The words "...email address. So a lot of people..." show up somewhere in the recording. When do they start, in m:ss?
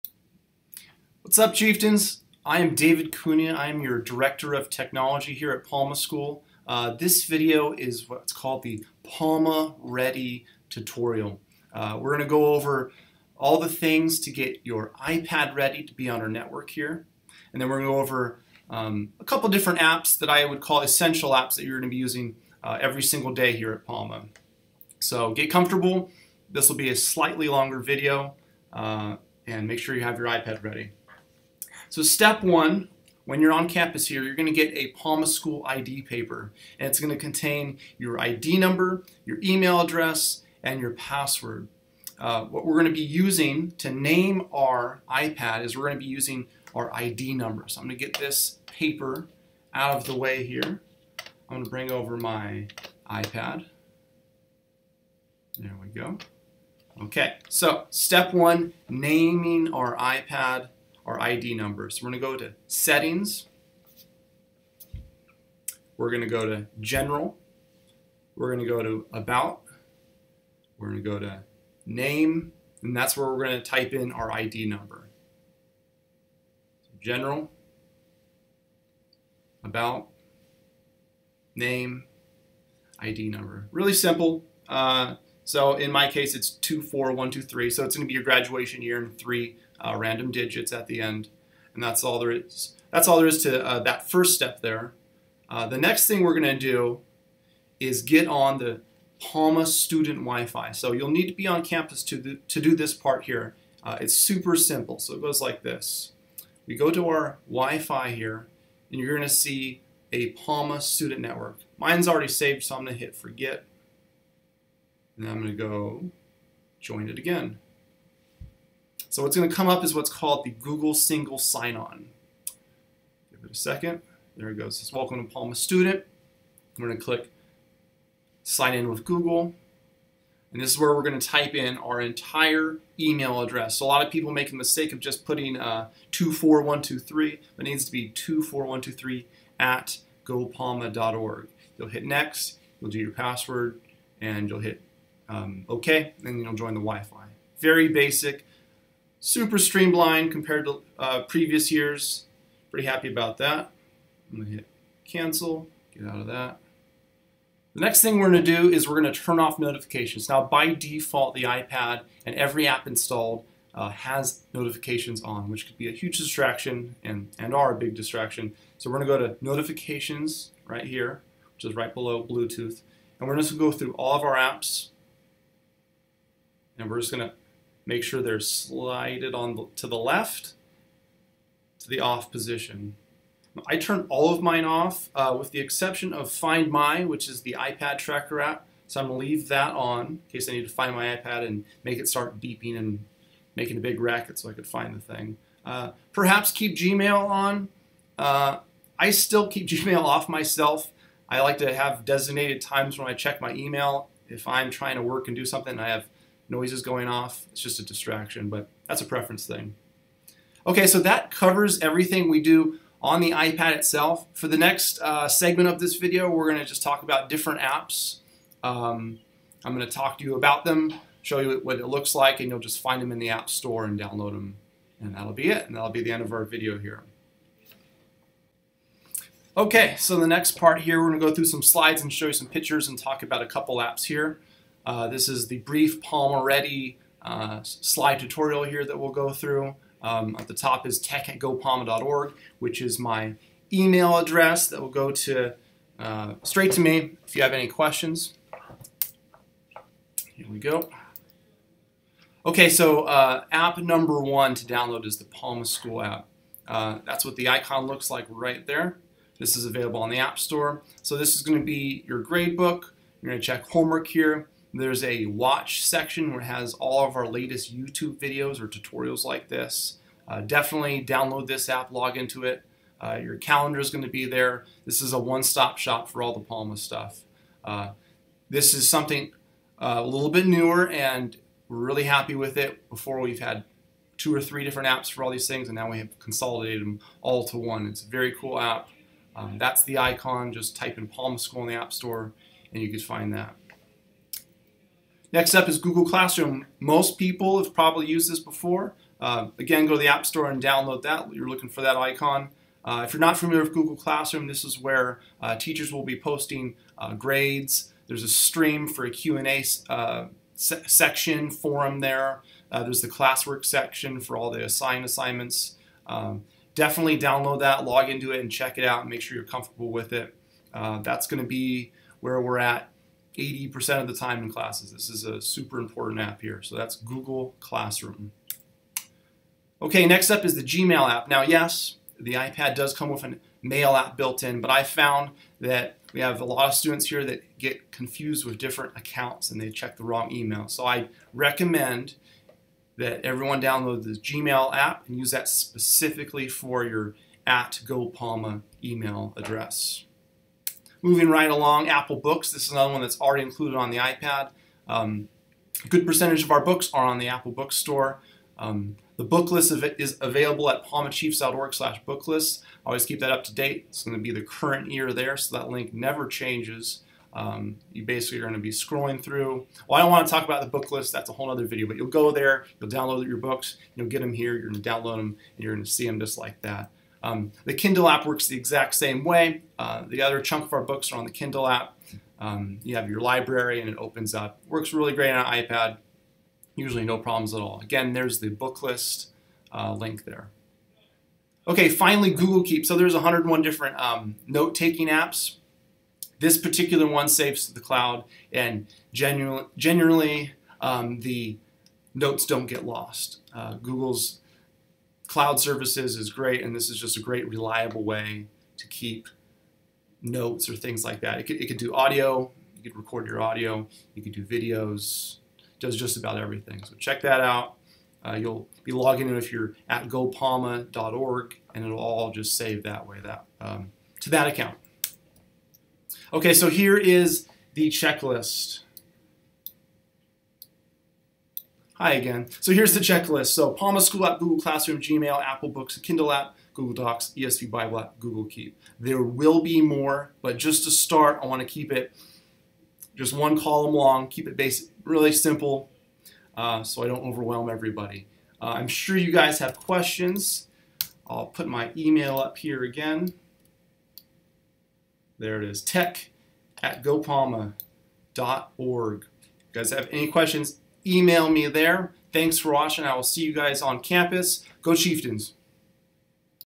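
2:12.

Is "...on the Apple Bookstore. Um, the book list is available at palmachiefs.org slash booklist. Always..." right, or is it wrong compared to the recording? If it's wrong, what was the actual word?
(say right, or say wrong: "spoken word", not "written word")
right.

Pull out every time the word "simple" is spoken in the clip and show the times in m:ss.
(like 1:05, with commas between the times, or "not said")
1:23, 1:44, 7:25.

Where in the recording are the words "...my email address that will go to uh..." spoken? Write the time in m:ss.
4:02.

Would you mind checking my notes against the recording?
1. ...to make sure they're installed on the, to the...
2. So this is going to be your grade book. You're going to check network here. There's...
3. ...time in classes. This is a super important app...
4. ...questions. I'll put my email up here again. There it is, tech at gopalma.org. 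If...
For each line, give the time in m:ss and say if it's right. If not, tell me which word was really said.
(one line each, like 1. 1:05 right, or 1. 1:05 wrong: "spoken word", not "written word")
1. 2:57 wrong: "slided", not "installed"
2. 4:21 wrong: "homework", not "network"
3. 5:24 right
4. 7:29 right.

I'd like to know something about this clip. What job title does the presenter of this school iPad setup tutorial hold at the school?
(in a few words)
Director of Technology.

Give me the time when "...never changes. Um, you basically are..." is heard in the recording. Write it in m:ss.
6:05.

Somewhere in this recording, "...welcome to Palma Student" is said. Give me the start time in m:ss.
2:04.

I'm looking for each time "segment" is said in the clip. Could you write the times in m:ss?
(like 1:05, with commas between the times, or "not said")
3:35.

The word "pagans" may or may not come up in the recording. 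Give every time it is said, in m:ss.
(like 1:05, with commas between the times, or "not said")
not said.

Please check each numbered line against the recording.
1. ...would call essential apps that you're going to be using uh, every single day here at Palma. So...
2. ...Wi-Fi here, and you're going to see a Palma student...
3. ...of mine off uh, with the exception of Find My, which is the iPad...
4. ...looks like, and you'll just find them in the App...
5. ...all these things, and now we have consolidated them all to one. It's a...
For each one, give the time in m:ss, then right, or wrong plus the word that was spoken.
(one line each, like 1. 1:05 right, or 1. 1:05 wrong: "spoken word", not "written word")
1. 0:20 right
2. 1:47 right
3. 3:04 right
4. 3:41 right
5. 4:45 right.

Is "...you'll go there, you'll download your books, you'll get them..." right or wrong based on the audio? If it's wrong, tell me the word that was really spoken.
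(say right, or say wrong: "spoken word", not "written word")
right.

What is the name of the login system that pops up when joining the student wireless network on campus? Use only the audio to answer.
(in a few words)
Google Single Sign-On.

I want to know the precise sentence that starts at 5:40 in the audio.
So I recommend that everyone download the Gmail app and use that specifically for your at GoPalma email address.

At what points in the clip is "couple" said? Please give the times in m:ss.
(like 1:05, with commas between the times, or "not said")
0:19, 3:53.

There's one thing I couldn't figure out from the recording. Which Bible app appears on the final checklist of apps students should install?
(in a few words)
ESV Bible app.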